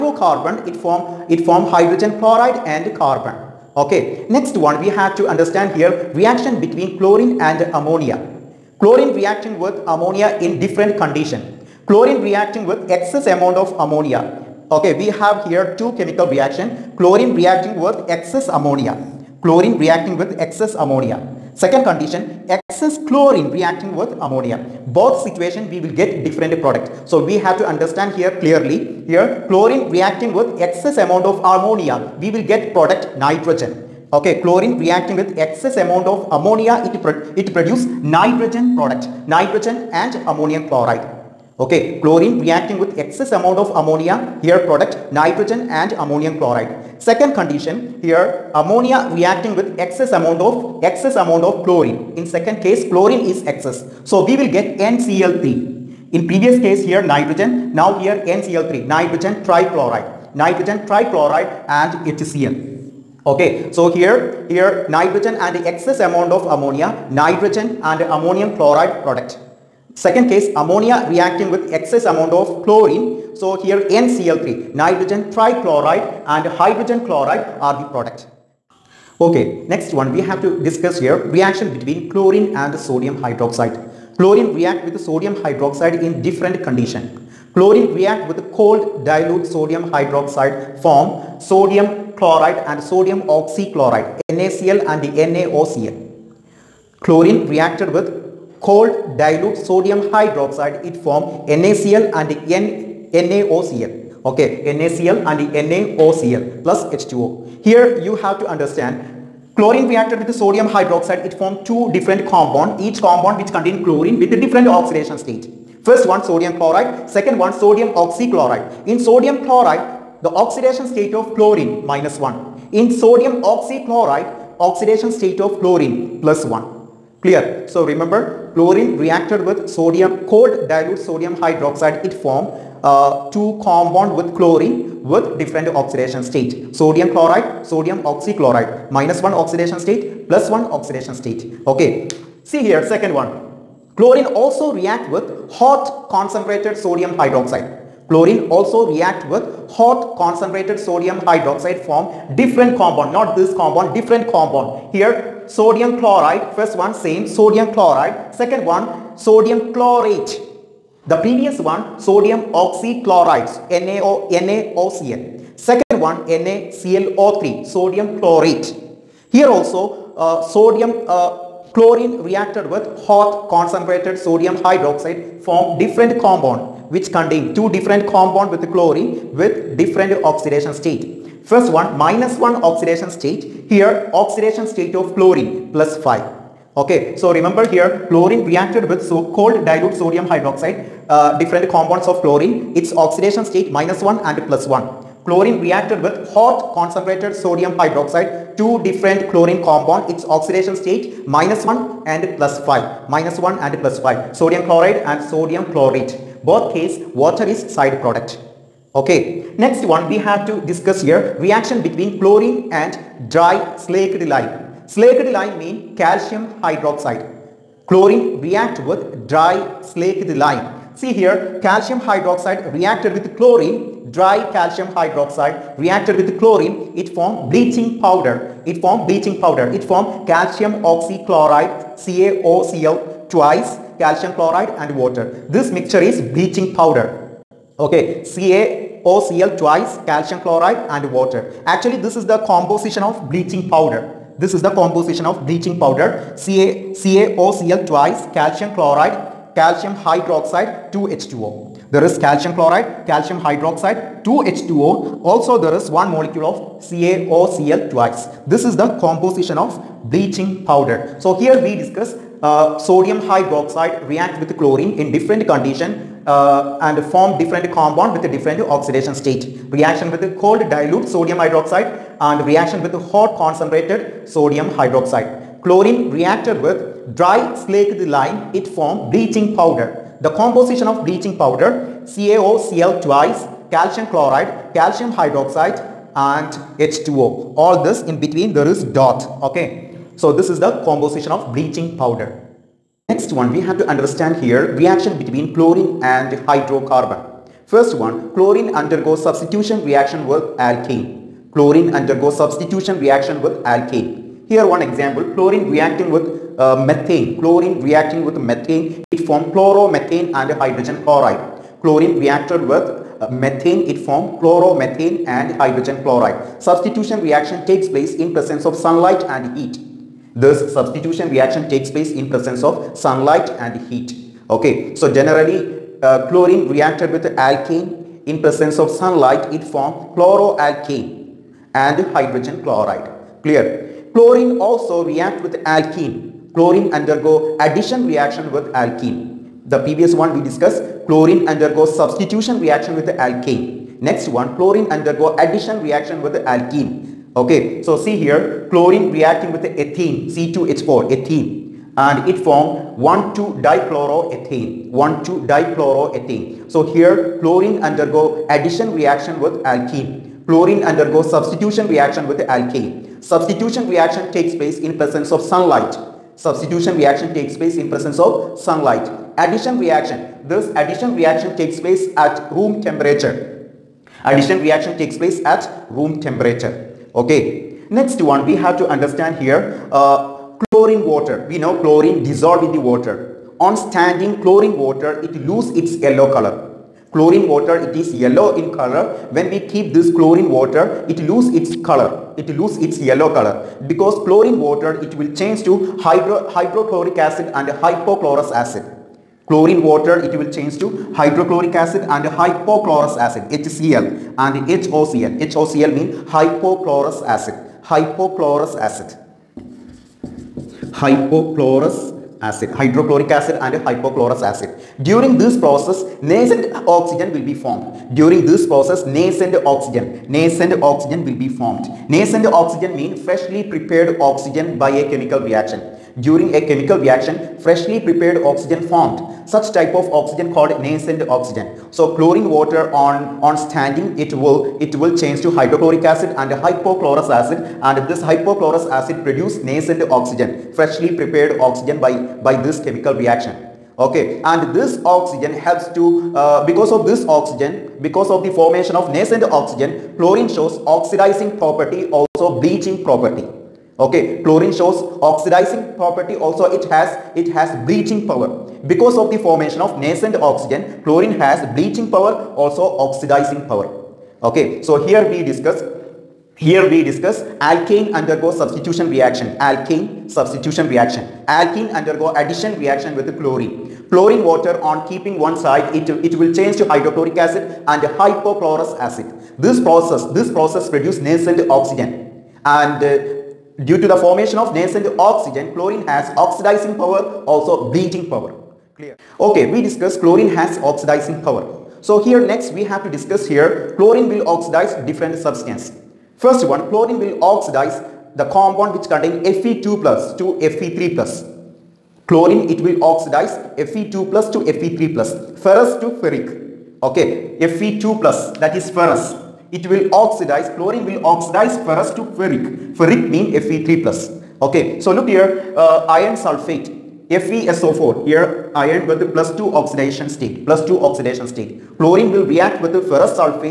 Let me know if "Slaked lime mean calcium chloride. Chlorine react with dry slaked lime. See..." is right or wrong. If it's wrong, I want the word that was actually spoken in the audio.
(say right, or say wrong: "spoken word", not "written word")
wrong: "hydroxide", not "chloride".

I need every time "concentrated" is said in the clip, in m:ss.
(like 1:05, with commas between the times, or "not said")
2:26, 2:30, 2:53, 3:16, 4:33.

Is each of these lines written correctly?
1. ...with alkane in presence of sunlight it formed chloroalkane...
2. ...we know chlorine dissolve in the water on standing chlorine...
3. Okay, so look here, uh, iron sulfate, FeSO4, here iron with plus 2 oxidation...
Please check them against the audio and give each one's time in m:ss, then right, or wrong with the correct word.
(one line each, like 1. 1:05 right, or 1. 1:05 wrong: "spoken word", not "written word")
1. 5:27 right
2. 6:21 right
3. 8:34 right.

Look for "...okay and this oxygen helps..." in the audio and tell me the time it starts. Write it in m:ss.
7:24.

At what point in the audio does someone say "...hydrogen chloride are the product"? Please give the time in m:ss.
1:16.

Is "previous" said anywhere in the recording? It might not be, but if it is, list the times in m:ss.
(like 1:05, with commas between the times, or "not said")
0:56, 2:41, 5:39.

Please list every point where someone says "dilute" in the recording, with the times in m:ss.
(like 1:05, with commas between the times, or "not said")
1:29, 1:39, 2:10, 3:09, 4:30.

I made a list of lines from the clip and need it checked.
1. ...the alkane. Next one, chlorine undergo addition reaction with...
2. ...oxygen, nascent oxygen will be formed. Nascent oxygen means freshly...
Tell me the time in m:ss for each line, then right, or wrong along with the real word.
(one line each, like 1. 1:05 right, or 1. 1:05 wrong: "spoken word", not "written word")
1. 5:43 right
2. 6:59 right.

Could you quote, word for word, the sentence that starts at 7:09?
Such type of oxygen called nascent oxygen.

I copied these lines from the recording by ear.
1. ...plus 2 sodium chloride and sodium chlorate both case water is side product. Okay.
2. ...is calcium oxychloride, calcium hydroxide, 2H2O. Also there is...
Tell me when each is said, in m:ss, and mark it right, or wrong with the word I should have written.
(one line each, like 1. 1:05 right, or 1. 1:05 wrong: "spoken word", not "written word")
1. 3:23 wrong: "5", not "2"
2. 4:12 wrong: "chloride", not "oxychloride".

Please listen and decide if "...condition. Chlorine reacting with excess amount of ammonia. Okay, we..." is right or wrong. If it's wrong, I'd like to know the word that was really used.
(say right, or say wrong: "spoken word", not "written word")
right.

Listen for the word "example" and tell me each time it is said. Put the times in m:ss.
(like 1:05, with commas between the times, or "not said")
5:04.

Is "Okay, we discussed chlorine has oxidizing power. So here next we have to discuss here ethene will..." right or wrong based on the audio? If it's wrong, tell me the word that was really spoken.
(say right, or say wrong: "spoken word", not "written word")
wrong: "chlorine", not "ethene".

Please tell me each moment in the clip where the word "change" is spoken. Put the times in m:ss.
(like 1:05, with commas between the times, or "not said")
6:35, 6:40, 7:15, 7:56.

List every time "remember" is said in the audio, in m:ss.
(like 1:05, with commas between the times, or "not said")
2:07, 3:07.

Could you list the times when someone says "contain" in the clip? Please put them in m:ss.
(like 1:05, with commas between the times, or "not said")
1:53, 2:57, 8:19.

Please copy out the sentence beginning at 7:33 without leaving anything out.
Okay, chlorine shows oxidizing property also it has it has bleaching power.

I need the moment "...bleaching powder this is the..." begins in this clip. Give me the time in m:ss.
4:03.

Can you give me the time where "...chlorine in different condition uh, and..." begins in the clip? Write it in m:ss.
4:24.